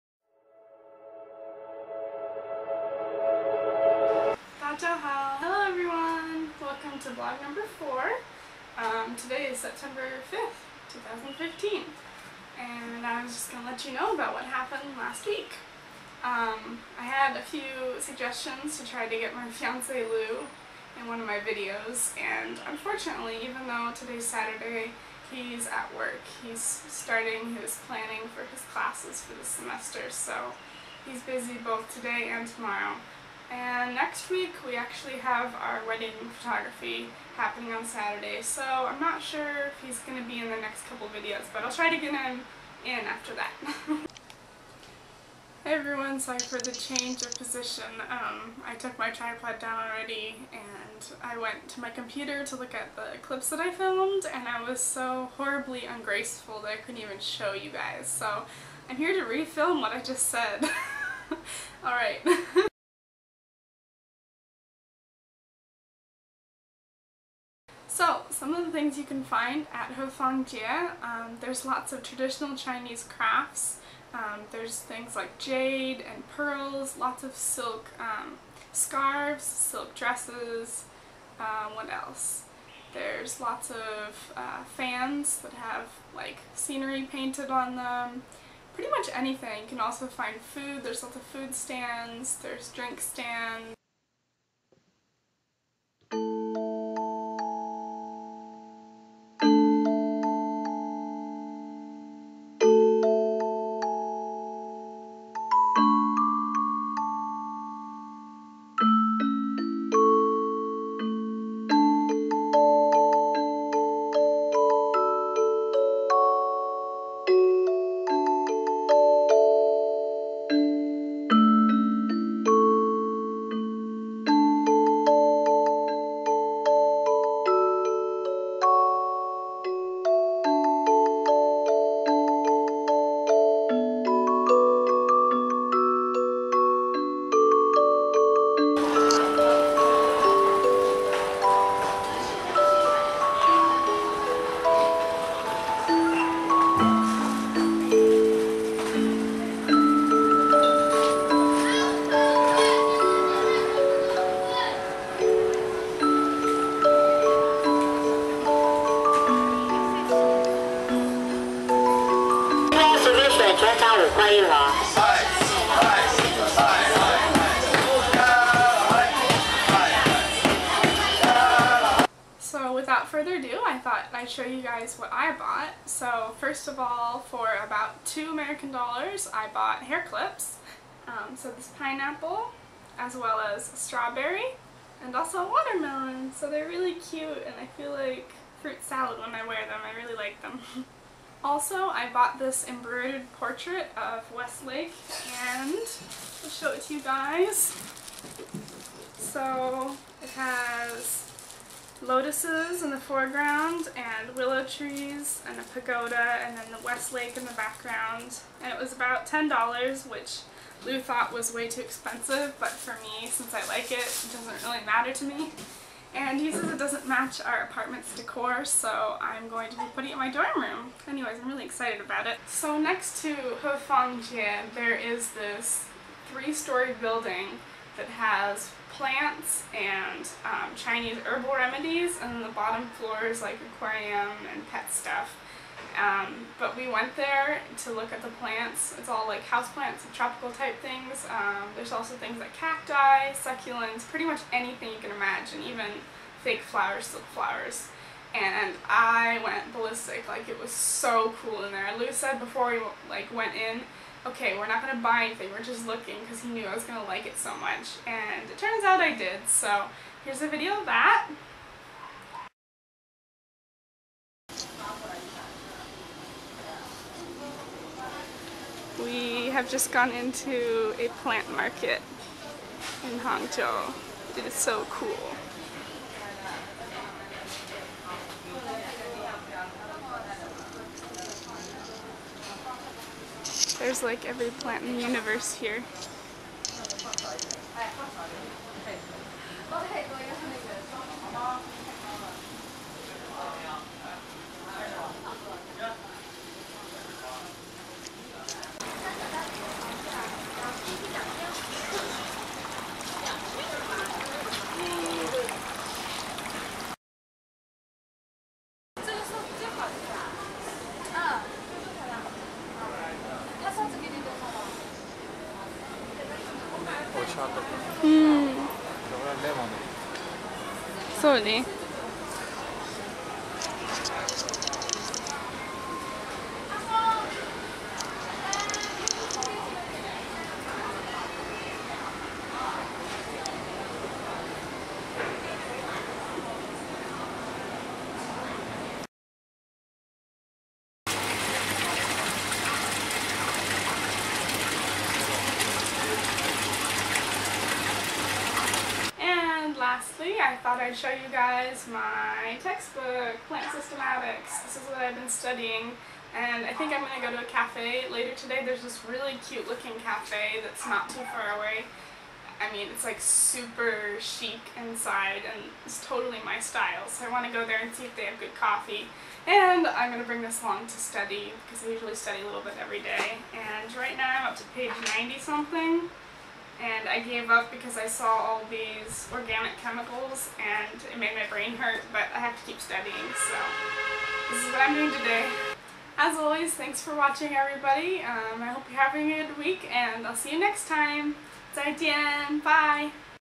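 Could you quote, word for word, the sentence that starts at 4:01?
Um, there's also things like cacti, succulents, pretty much anything you can imagine, even fake flowers, silk flowers.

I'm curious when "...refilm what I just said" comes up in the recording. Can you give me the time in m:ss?
0:59.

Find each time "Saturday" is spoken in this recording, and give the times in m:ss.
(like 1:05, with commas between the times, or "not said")
0:24, 0:37.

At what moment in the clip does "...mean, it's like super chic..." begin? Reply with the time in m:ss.
6:02.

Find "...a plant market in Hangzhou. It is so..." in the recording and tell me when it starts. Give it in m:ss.
4:30.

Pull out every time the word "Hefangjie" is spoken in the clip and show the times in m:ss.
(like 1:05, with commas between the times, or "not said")
1:09, 3:43.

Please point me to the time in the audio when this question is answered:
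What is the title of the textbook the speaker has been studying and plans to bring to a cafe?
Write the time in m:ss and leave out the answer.
5:53.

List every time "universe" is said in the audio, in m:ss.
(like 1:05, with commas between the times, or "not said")
4:45.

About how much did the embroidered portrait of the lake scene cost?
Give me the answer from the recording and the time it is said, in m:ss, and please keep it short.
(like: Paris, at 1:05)
$10, at 3:29.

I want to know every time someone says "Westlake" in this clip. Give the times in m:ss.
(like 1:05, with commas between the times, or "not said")
3:14, 3:26.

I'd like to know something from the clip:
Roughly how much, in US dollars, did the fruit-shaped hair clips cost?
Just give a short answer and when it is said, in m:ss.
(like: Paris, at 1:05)
2 dollars, at 2:58.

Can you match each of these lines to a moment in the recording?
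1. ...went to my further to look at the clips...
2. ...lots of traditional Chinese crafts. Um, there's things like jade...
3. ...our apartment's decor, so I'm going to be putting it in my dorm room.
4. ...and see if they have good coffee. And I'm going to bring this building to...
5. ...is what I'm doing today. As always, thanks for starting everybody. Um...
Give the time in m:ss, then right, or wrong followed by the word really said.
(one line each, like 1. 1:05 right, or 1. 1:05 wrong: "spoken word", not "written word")
1. 0:51 wrong: "computer", not "further"
2. 1:11 right
3. 3:37 right
4. 6:07 wrong: "along", not "building"
5. 6:24 wrong: "watching", not "starting".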